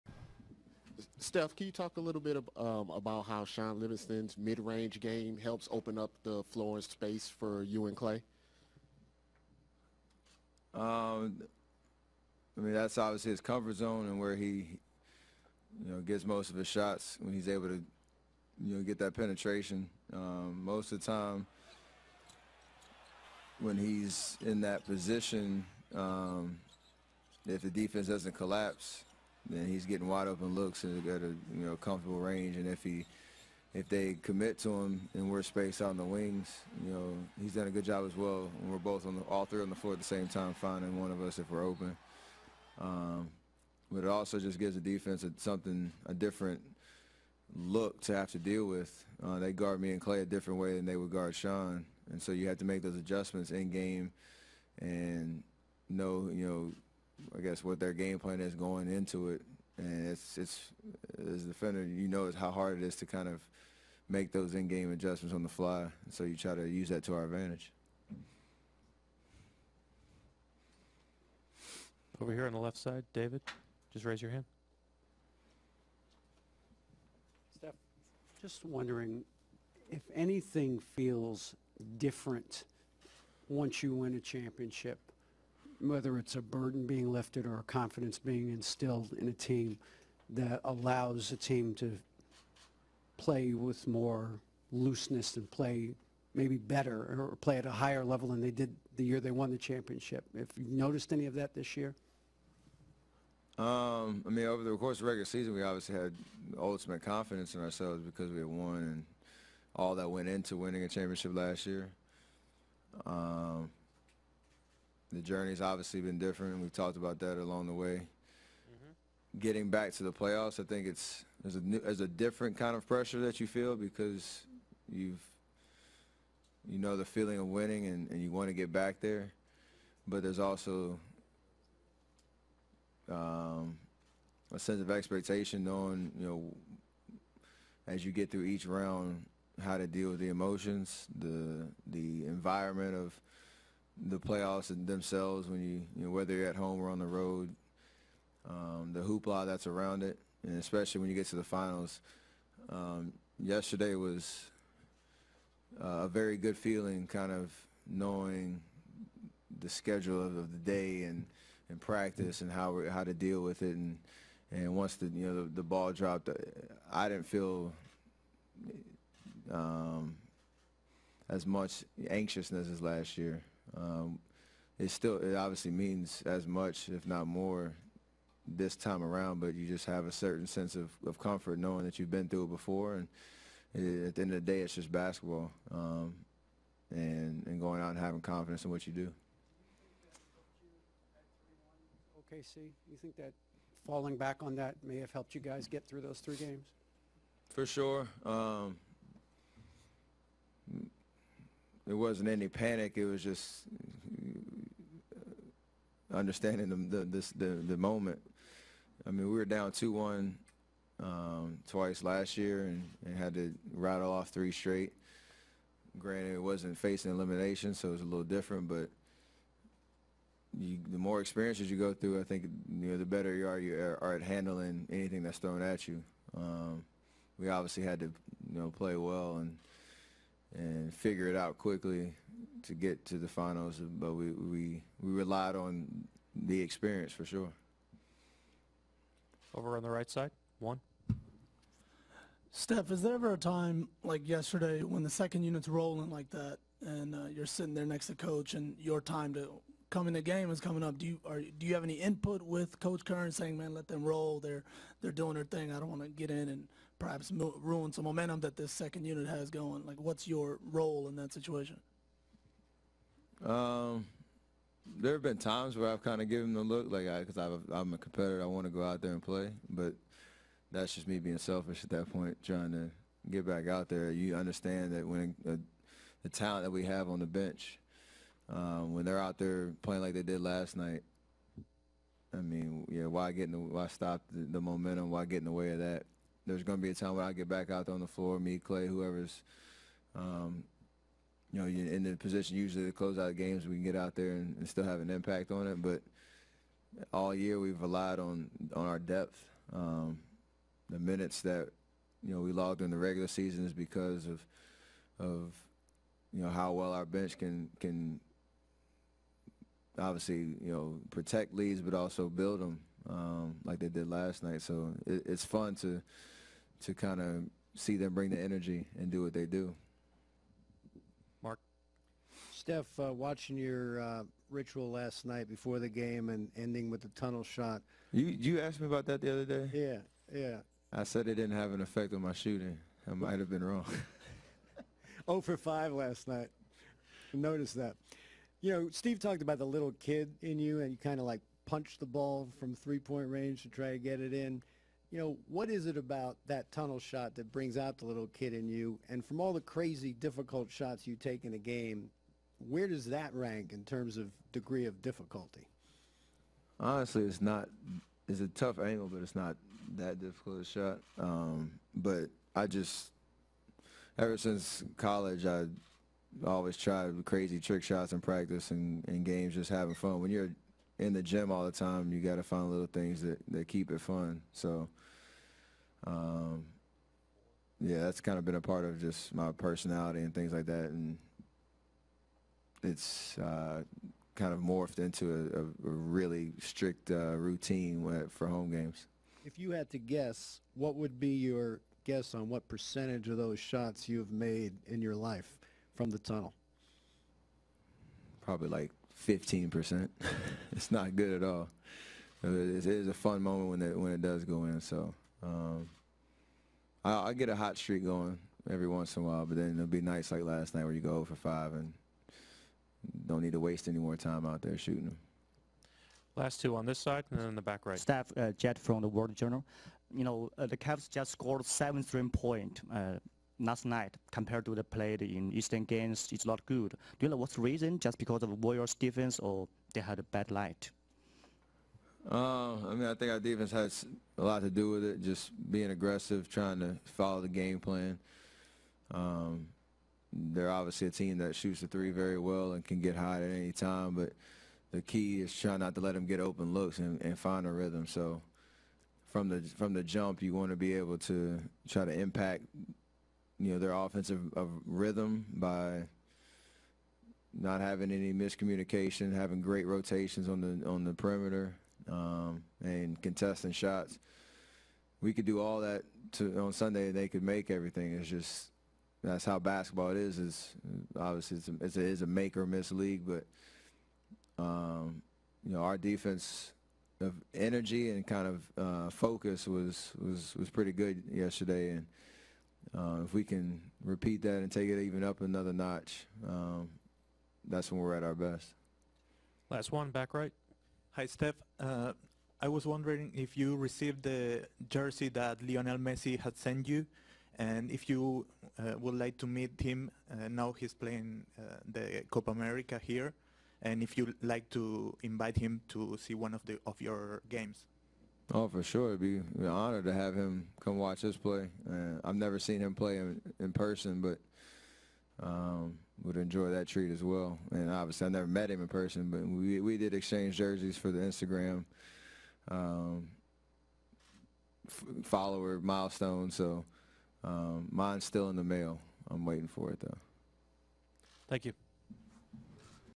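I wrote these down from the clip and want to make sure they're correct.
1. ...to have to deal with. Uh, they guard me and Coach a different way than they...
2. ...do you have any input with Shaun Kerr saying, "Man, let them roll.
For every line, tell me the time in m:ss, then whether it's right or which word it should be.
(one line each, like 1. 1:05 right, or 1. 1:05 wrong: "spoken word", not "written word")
1. 0:48 wrong: "Klay", not "Coach"
2. 4:11 wrong: "Coach", not "Shaun".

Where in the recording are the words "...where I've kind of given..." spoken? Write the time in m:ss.
4:25.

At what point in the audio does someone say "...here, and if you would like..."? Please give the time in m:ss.
8:23.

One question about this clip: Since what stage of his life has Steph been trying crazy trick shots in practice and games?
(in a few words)
college.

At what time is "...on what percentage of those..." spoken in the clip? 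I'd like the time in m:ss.
6:32.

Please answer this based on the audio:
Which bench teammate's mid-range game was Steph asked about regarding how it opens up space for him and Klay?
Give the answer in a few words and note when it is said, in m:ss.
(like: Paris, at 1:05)
Shaun Livingston, at 0:03.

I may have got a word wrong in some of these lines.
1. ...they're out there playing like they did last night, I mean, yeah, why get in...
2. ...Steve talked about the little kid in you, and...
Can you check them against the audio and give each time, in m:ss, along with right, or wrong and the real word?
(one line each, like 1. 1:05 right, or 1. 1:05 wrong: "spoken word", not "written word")
1. 4:39 right
2. 5:38 right.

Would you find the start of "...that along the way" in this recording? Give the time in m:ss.
1:57.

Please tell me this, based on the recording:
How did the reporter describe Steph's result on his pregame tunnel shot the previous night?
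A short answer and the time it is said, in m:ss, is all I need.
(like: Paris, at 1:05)
0 for 5, at 5:35.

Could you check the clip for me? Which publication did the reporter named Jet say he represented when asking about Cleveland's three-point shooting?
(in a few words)
World Journal.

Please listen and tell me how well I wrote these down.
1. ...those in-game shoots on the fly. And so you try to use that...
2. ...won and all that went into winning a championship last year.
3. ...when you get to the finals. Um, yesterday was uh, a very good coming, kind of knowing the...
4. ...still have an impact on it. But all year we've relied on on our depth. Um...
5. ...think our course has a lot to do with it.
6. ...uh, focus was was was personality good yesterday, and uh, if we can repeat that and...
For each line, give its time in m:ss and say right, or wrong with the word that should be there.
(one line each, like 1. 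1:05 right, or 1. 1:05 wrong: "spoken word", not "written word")
1. 1:04 wrong: "adjustments", not "shoots"
2. 1:48 right
3. 2:31 wrong: "feeling", not "coming"
4. 4:54 right
5. 7:13 wrong: "defense", not "course"
6. 7:58 wrong: "pretty", not "personality".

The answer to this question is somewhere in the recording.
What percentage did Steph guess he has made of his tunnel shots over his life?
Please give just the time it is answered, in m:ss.
6:39.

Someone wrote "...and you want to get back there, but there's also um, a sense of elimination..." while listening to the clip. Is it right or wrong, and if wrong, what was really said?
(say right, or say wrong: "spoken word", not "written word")
wrong: "expectation", not "elimination".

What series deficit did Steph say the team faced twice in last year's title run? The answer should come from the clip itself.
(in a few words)
two one.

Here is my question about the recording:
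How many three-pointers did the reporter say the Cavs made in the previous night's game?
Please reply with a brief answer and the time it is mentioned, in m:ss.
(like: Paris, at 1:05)
7, at 7:01.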